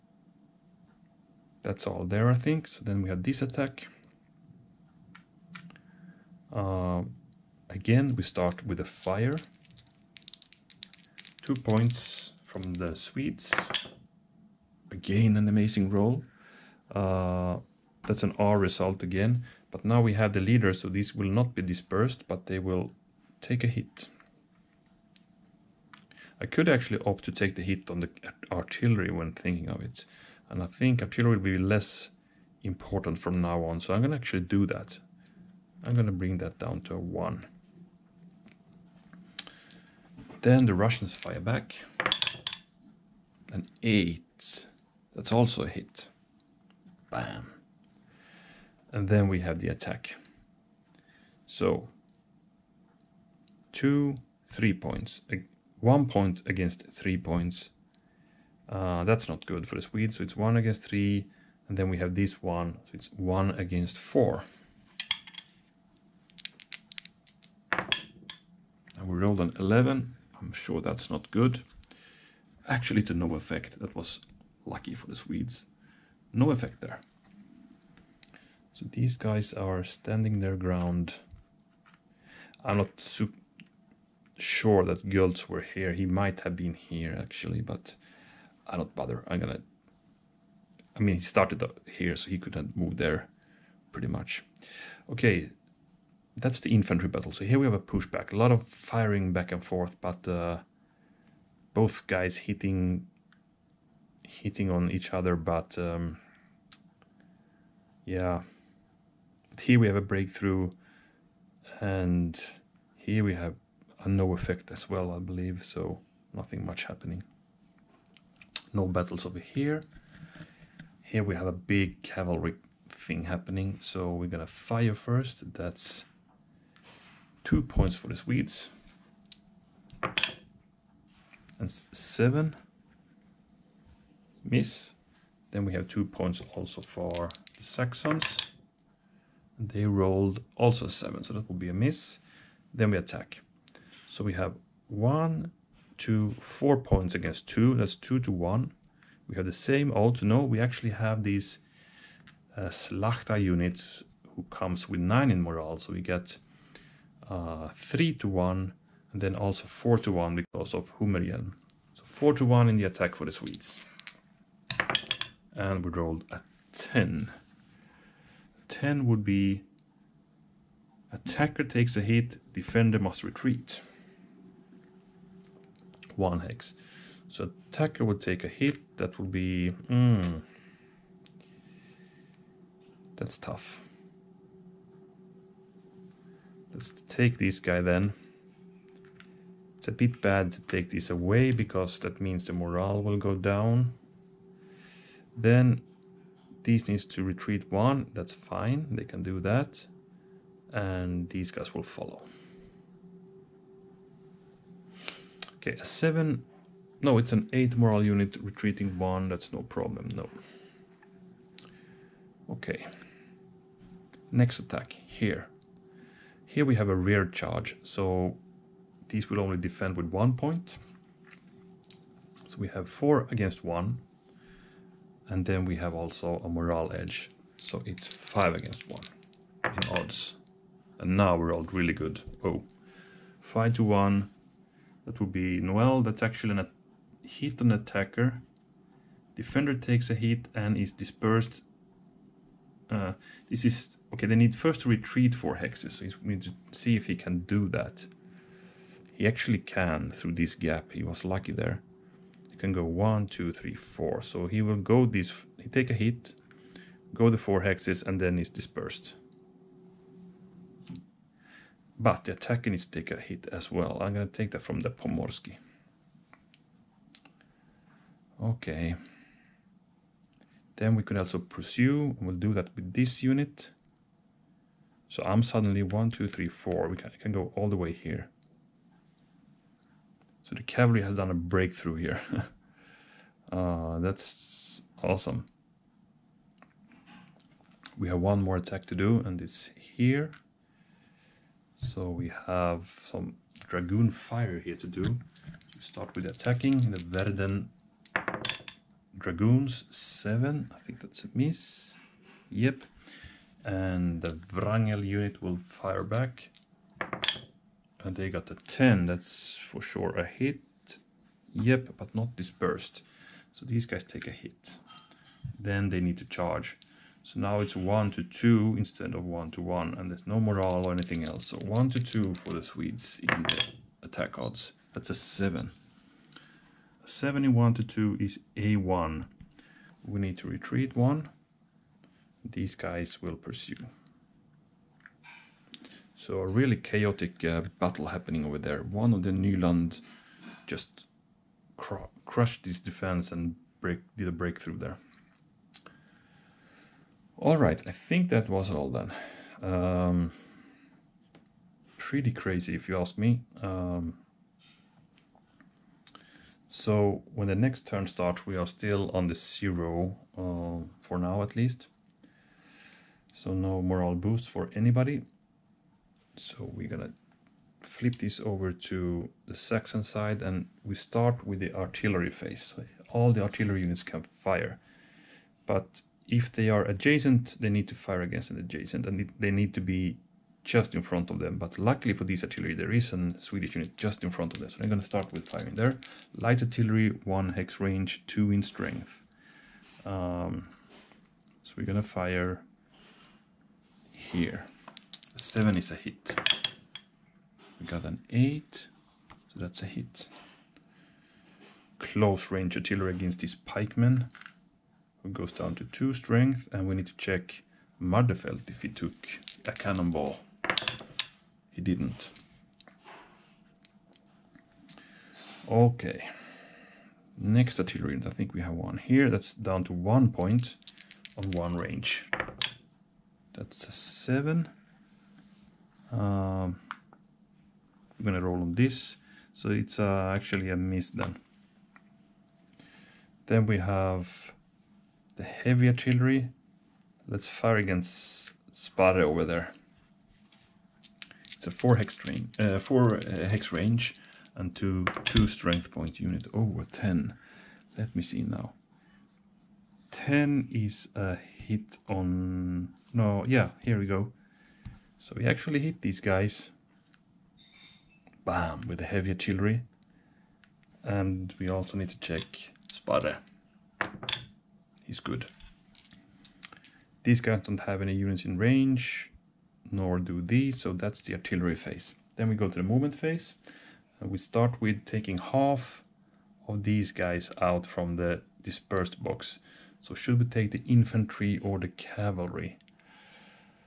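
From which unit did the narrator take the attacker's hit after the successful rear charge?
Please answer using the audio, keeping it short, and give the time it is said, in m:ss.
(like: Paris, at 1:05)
Pomorski, at 4:24.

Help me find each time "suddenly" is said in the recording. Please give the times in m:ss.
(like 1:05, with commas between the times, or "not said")
4:35.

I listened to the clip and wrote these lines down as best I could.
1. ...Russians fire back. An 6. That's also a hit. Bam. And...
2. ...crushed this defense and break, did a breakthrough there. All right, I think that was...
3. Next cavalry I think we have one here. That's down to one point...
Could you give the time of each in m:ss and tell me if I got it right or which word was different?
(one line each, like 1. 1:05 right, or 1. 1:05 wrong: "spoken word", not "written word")
1. 0:40 wrong: "8", not "6"
2. 5:42 right
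3. 6:57 wrong: "artillery", not "cavalry".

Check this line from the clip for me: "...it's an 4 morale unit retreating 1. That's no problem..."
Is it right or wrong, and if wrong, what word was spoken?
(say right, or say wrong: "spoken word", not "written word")
wrong: "8", not "4".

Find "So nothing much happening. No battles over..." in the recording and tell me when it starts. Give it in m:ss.
1:55.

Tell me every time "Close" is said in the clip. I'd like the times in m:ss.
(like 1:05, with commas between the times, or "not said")
6:41.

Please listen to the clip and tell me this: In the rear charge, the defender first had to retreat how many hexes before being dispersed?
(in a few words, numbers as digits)
4.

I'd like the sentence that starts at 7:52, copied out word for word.
Then we go to the movement phase.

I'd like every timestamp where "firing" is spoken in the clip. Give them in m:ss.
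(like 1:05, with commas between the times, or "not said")
1:38, 6:25.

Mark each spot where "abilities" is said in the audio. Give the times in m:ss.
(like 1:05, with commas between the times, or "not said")
not said.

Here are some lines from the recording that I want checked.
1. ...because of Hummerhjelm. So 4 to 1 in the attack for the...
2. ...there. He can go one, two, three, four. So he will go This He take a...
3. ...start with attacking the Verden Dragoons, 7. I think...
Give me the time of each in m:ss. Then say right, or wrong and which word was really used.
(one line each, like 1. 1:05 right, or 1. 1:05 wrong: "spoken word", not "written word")
1. 2:40 right
2. 4:11 right
3. 4:55 right.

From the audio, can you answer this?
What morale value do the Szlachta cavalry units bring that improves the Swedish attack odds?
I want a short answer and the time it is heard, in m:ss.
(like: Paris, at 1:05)
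9, at 2:34.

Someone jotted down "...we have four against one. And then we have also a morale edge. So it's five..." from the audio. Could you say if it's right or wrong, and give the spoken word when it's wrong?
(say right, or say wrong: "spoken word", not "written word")
right.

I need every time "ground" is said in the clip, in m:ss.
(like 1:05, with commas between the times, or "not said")
1:20.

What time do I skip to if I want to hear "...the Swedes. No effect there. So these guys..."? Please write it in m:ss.
1:15.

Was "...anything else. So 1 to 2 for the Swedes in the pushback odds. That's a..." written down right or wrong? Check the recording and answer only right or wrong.
wrong.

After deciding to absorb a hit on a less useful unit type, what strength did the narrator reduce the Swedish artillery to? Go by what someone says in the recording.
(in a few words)
1.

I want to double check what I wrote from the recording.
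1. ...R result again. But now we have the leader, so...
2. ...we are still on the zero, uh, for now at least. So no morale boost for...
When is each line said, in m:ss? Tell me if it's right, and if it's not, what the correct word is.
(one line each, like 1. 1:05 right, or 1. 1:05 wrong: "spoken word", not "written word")
1. 0:18 right
2. 5:58 right.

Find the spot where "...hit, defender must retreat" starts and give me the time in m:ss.
2:52.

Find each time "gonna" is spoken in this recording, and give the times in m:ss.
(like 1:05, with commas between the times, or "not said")
1:29, 2:04, 6:06, 7:08.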